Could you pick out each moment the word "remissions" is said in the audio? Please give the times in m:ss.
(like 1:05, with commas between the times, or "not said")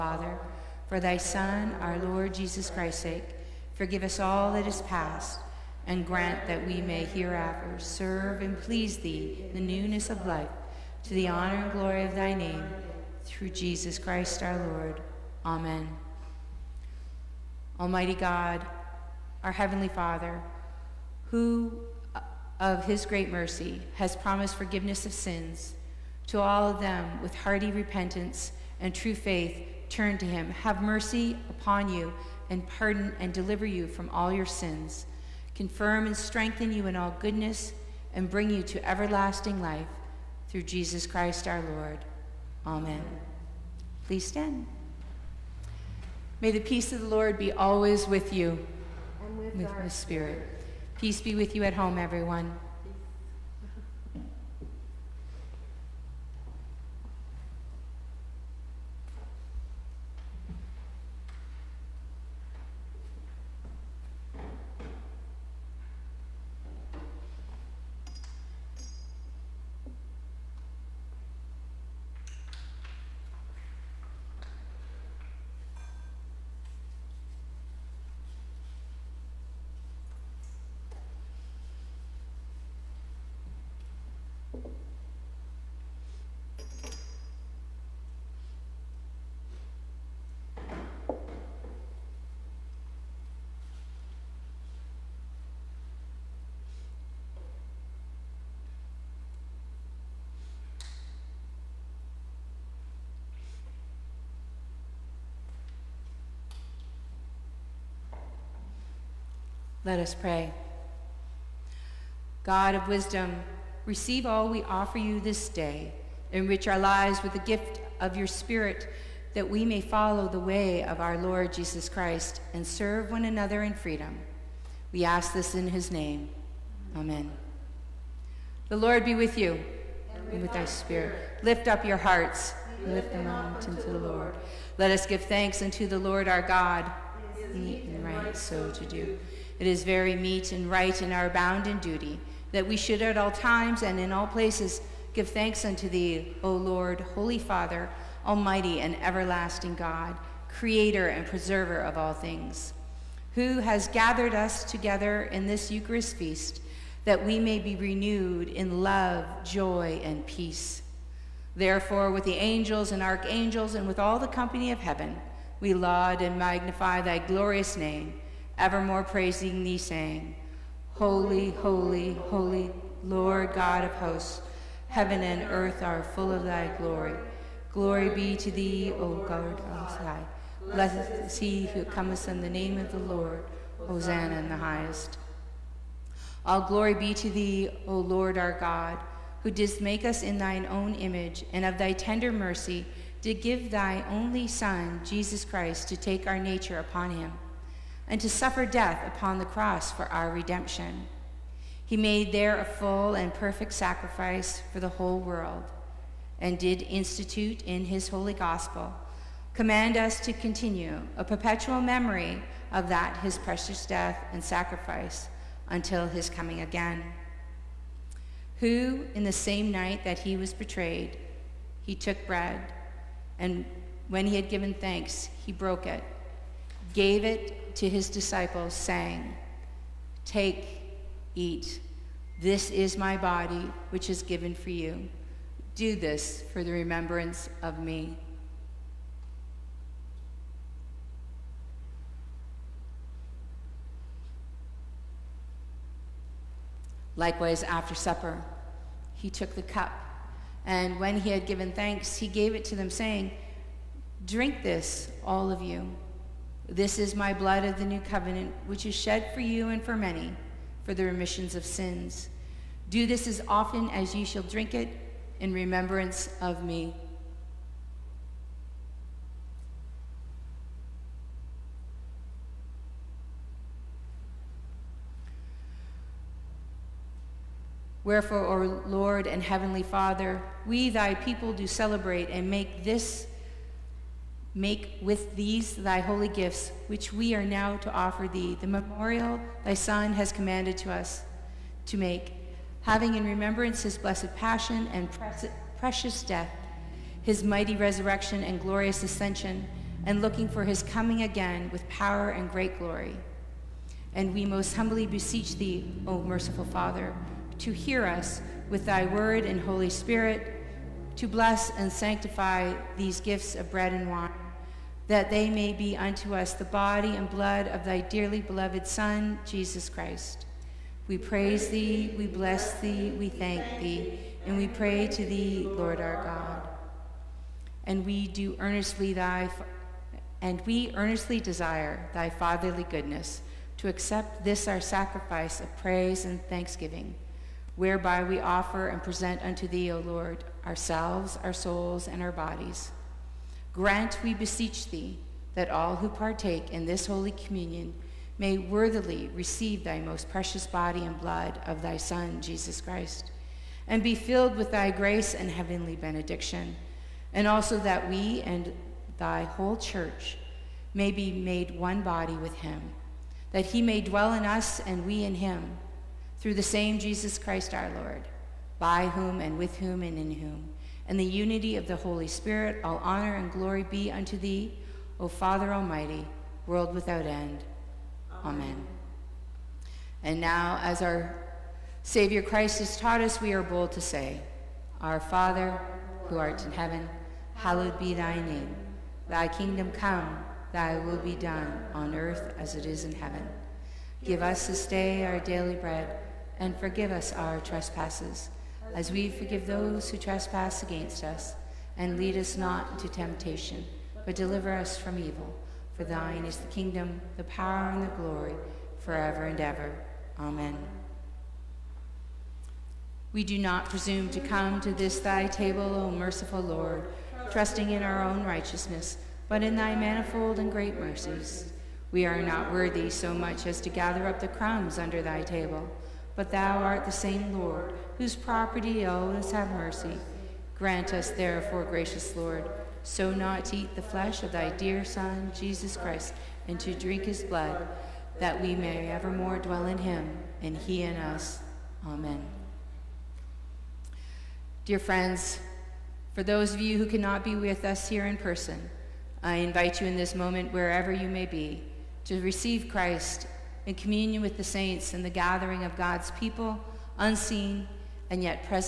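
4:21.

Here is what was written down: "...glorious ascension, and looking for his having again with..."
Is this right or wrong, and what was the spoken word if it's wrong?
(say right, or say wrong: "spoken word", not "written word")
wrong: "coming", not "having".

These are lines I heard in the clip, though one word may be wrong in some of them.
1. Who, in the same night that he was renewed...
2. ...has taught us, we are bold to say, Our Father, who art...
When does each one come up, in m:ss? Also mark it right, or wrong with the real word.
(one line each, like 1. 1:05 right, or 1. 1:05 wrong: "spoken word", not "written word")
1. 3:38 wrong: "betrayed", not "renewed"
2. 6:22 right.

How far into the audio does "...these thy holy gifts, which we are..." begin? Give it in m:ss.
4:45.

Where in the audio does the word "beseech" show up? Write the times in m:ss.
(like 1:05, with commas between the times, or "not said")
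5:05, 5:44.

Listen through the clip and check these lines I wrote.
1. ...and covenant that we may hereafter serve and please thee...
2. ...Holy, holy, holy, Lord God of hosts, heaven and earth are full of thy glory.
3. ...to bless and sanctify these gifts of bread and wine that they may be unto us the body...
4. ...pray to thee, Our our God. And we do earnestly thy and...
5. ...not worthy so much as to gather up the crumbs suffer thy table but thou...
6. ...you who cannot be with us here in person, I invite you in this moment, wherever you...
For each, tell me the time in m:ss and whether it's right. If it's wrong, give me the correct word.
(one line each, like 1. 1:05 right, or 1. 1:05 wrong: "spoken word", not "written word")
1. 0:05 wrong: "grant", not "covenant"
2. 2:50 right
3. 5:11 right
4. 5:24 wrong: "Lord", not "Our"
5. 7:02 wrong: "under", not "suffer"
6. 7:26 right.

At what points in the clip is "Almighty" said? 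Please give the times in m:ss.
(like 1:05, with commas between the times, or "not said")
0:17, 2:28, 6:15.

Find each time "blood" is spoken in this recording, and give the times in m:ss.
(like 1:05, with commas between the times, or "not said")
4:17, 5:17, 5:51, 7:17.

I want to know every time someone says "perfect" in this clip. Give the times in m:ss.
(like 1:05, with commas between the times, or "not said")
3:23.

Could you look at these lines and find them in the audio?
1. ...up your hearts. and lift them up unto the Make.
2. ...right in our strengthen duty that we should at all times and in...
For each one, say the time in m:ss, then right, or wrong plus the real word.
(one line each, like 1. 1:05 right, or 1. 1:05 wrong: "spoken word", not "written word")
1. 2:11 wrong: "Lord", not "Make"
2. 2:20 wrong: "bounden", not "strengthen".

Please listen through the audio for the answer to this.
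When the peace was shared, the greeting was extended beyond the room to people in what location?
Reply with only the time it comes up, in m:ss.
0:51.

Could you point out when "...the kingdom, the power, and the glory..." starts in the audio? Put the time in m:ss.
6:46.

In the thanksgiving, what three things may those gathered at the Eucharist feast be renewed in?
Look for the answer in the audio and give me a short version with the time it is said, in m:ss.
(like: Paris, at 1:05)
Love, joy, and peace, at 2:38.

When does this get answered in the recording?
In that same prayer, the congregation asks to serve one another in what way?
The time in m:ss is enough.
2:03.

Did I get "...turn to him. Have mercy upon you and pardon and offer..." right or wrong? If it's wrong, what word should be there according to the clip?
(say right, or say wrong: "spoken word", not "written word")
wrong: "deliver", not "offer".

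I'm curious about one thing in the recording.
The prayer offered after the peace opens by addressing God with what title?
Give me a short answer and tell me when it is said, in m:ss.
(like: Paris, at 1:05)
God of wisdom, at 1:52.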